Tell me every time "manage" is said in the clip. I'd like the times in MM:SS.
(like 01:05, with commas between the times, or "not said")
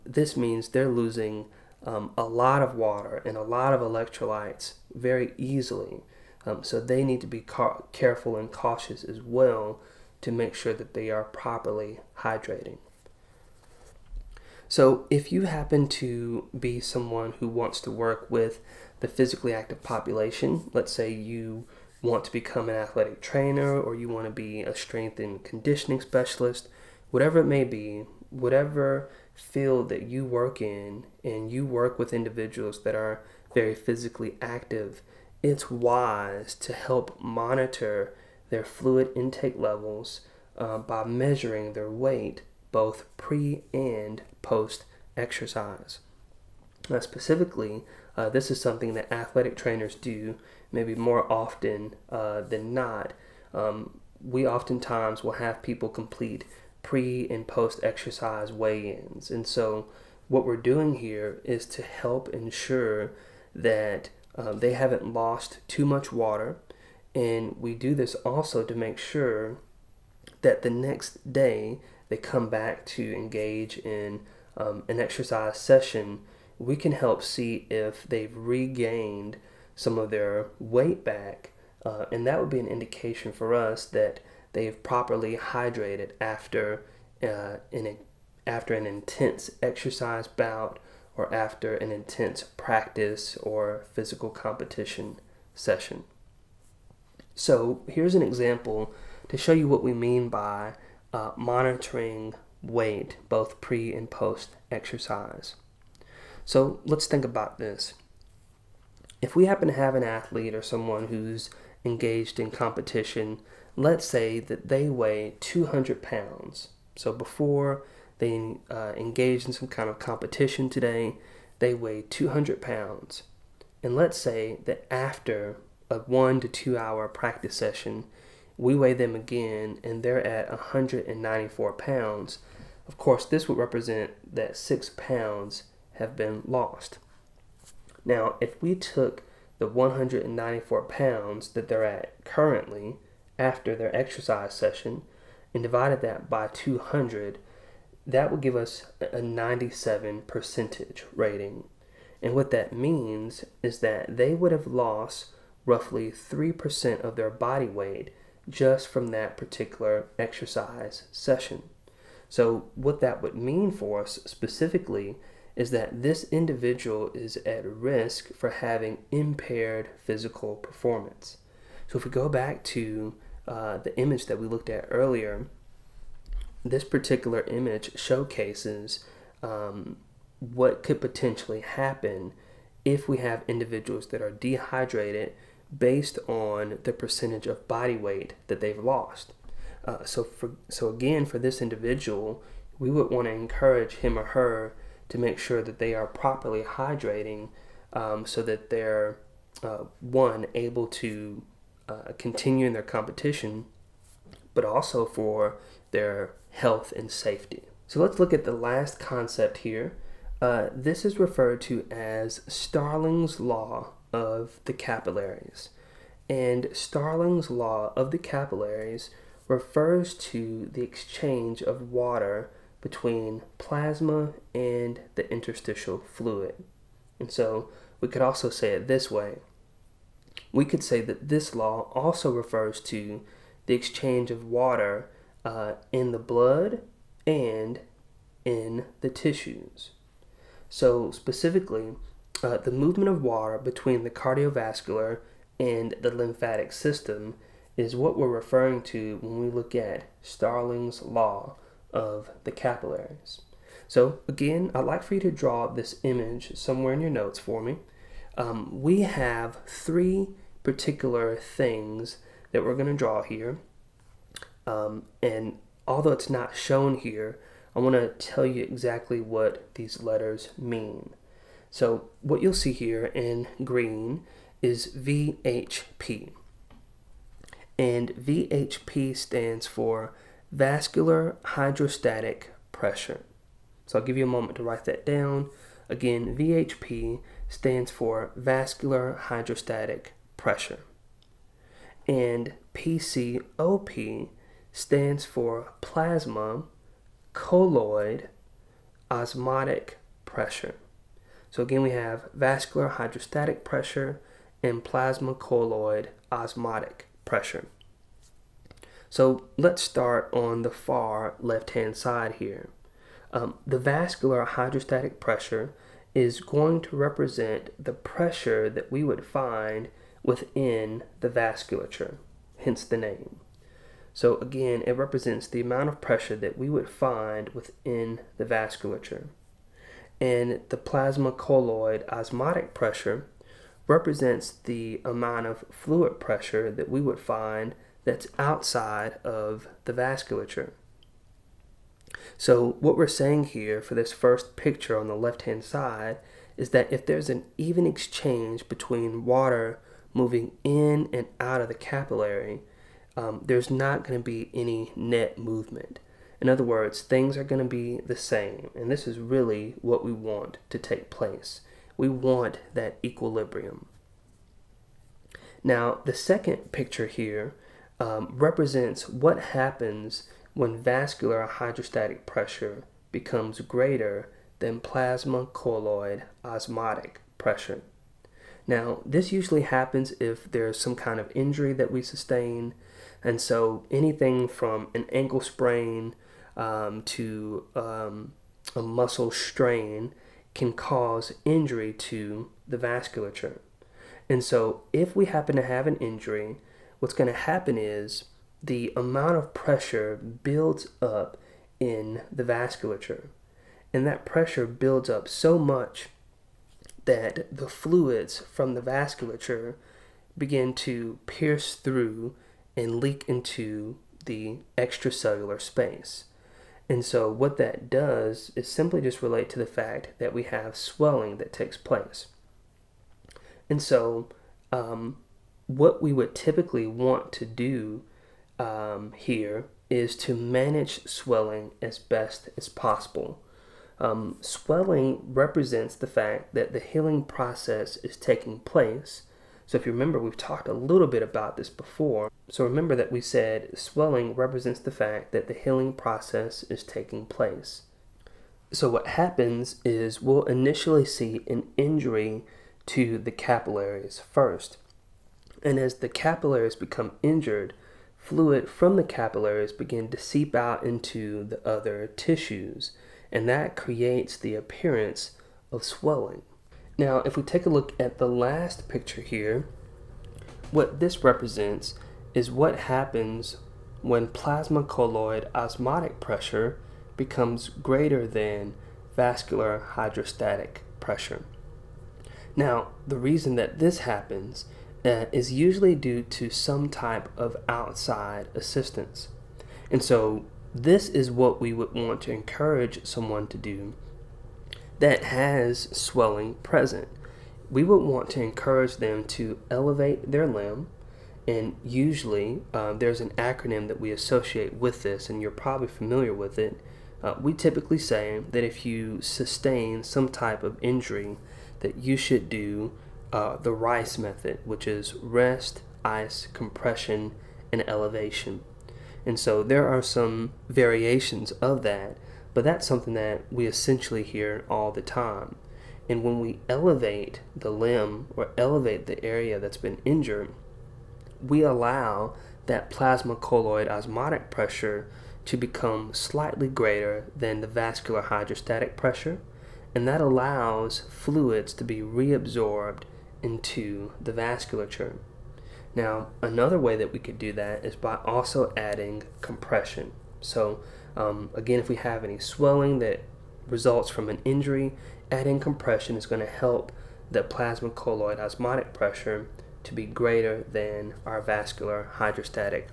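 07:10.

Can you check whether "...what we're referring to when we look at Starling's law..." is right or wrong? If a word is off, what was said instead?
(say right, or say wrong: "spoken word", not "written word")
right.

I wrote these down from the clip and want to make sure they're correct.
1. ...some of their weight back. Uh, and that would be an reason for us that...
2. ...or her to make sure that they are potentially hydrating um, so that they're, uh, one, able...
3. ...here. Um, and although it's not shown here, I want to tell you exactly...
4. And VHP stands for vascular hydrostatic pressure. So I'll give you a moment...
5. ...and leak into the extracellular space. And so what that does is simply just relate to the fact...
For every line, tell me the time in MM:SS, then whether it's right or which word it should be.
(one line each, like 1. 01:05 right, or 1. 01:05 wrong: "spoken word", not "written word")
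1. 01:19 wrong: "indication", not "reason"
2. 03:14 wrong: "properly", not "potentially"
3. 04:23 right
4. 04:37 right
5. 06:52 right.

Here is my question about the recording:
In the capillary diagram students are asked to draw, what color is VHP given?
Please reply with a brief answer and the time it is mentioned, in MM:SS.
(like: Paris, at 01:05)
green, at 04:33.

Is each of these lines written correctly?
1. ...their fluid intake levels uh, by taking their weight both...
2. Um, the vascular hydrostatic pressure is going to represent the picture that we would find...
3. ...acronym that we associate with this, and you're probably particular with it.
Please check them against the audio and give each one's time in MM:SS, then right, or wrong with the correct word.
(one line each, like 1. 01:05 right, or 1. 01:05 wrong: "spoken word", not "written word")
1. 00:38 wrong: "measuring", not "taking"
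2. 05:13 wrong: "pressure", not "picture"
3. 08:23 wrong: "familiar", not "particular".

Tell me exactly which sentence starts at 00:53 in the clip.
Um, we oftentimes will have people complete pre and post exercise weigh ins.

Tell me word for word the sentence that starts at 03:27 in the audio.
So let's look at the last concept here.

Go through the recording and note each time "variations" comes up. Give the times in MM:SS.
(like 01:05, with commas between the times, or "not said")
08:40.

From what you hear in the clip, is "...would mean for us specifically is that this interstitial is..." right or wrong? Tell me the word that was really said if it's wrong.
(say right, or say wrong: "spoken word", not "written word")
wrong: "individual", not "interstitial".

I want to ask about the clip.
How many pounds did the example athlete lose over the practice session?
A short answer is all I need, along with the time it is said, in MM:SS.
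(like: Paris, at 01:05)
6, at 02:14.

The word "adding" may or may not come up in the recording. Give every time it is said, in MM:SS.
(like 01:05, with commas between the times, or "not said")
09:08, 09:15.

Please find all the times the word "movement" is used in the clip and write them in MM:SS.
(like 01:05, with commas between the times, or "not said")
04:02, 05:55.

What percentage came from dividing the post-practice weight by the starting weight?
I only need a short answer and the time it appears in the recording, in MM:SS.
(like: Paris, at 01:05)
97, at 02:29.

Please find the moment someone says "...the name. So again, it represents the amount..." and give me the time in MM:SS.
05:22.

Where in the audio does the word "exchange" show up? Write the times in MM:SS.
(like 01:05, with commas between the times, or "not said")
03:40, 03:53, 05:47.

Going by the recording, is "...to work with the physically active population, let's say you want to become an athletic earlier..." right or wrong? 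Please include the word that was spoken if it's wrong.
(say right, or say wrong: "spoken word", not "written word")
wrong: "trainer", not "earlier".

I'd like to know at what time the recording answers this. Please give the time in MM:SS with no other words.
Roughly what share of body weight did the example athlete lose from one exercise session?
02:36.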